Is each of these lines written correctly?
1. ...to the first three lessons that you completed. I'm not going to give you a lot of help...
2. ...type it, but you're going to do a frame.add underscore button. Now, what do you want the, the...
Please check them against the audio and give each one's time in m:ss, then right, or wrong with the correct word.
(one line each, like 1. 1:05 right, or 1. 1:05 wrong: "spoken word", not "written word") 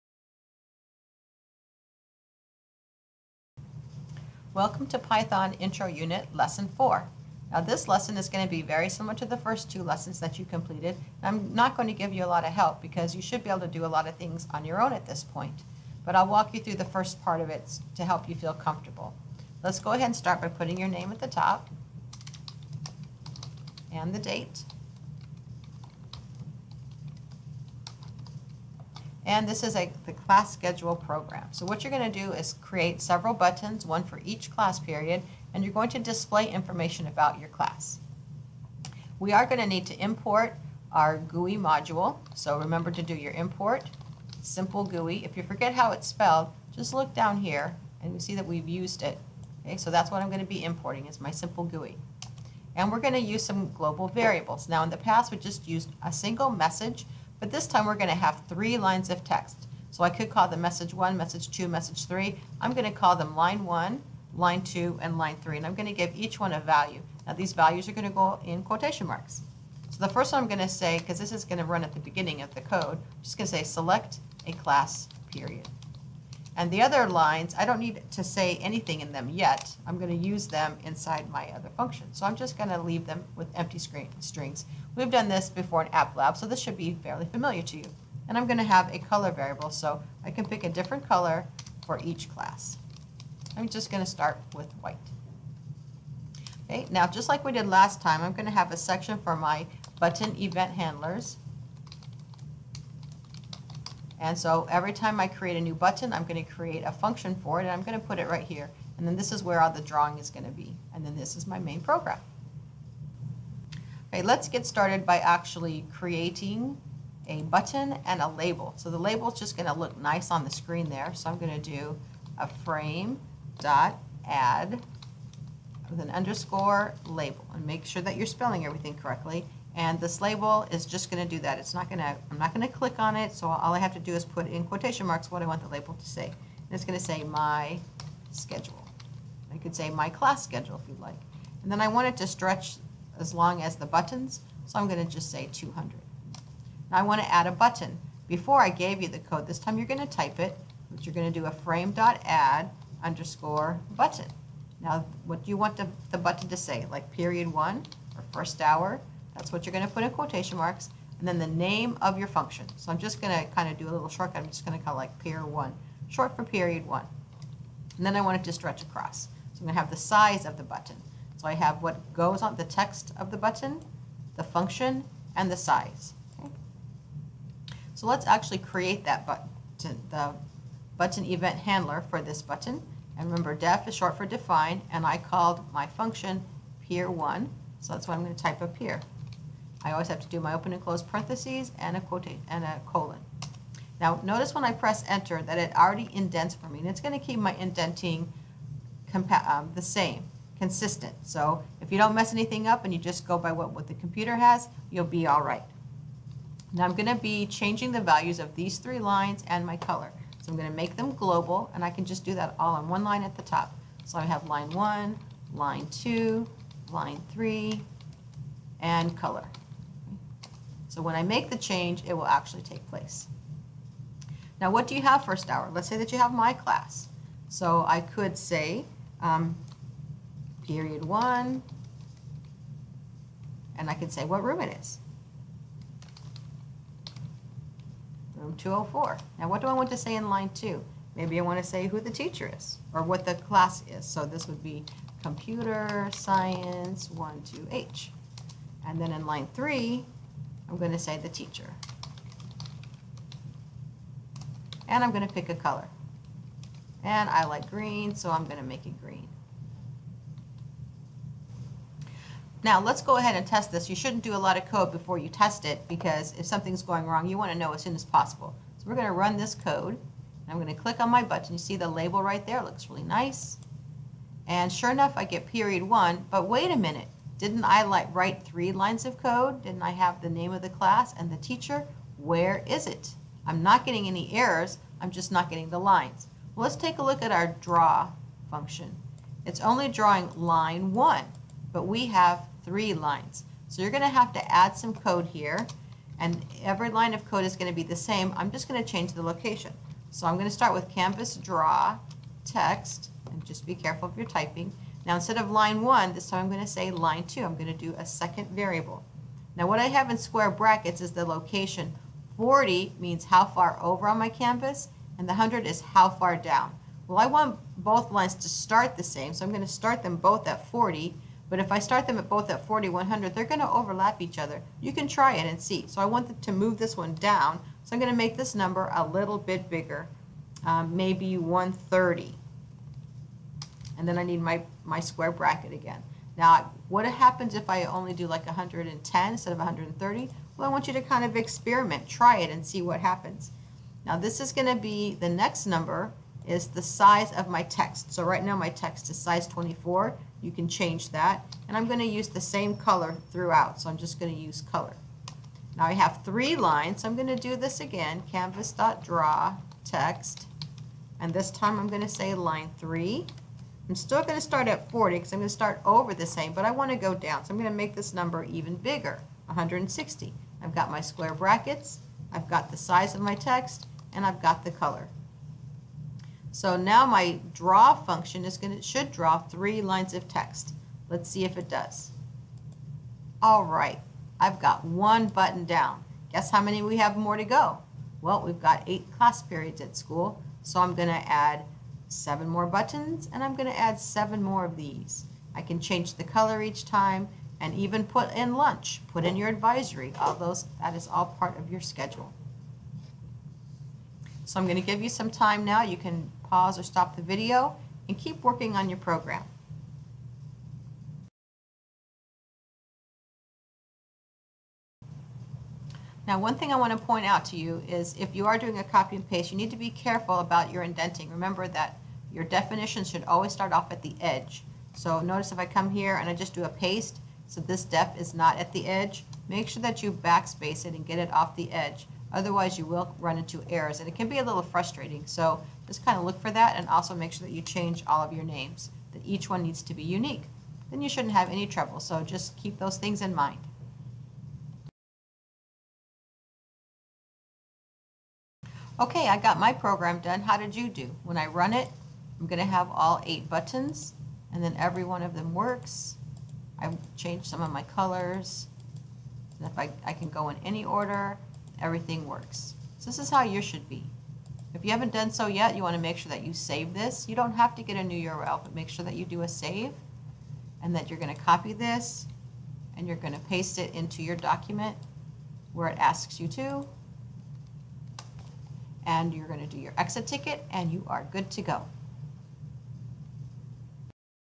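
1. 0:09 wrong: "two", not "three"
2. 2:30 right.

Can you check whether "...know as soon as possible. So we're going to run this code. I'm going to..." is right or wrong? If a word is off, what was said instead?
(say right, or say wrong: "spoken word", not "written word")
right.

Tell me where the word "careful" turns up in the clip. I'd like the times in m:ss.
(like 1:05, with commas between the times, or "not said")
5:03, 6:59.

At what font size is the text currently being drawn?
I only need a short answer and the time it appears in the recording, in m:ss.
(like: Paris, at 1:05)
24, at 5:49.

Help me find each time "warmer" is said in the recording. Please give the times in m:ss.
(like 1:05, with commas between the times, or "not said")
not said.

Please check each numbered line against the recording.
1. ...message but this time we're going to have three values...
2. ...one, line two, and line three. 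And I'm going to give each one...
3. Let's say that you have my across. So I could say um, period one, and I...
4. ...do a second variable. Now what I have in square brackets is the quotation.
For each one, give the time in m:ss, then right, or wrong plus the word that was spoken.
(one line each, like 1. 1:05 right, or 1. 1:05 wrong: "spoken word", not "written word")
1. 0:56 wrong: "lines", not "values"
2. 1:03 right
3. 3:45 wrong: "class", not "across"
4. 5:07 wrong: "location", not "quotation".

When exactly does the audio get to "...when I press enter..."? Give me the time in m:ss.
3:14.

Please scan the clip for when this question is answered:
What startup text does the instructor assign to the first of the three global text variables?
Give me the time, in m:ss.
1:13.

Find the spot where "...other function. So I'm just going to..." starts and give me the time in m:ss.
1:21.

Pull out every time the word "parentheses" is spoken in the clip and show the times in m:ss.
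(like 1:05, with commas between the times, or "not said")
3:11.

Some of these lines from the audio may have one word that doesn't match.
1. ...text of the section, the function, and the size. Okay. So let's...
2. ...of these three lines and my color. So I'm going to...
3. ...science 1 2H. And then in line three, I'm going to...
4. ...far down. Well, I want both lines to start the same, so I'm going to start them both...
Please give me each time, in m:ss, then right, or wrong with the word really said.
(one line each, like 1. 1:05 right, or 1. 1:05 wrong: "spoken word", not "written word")
1. 2:52 wrong: "button", not "section"
2. 3:28 right
3. 4:06 right
4. 5:16 right.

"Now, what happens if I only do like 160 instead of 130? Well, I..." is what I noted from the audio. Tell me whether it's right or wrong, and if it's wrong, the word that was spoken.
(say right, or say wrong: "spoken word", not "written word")
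wrong: "110", not "160".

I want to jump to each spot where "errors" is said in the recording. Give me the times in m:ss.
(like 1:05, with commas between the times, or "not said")
4:44, 7:13.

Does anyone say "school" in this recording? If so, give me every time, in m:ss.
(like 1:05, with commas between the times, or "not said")
6:29.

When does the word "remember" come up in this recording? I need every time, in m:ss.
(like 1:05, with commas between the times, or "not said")
0:42, 3:03, 7:01.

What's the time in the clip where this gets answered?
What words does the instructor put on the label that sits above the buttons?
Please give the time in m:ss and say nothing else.
2:17.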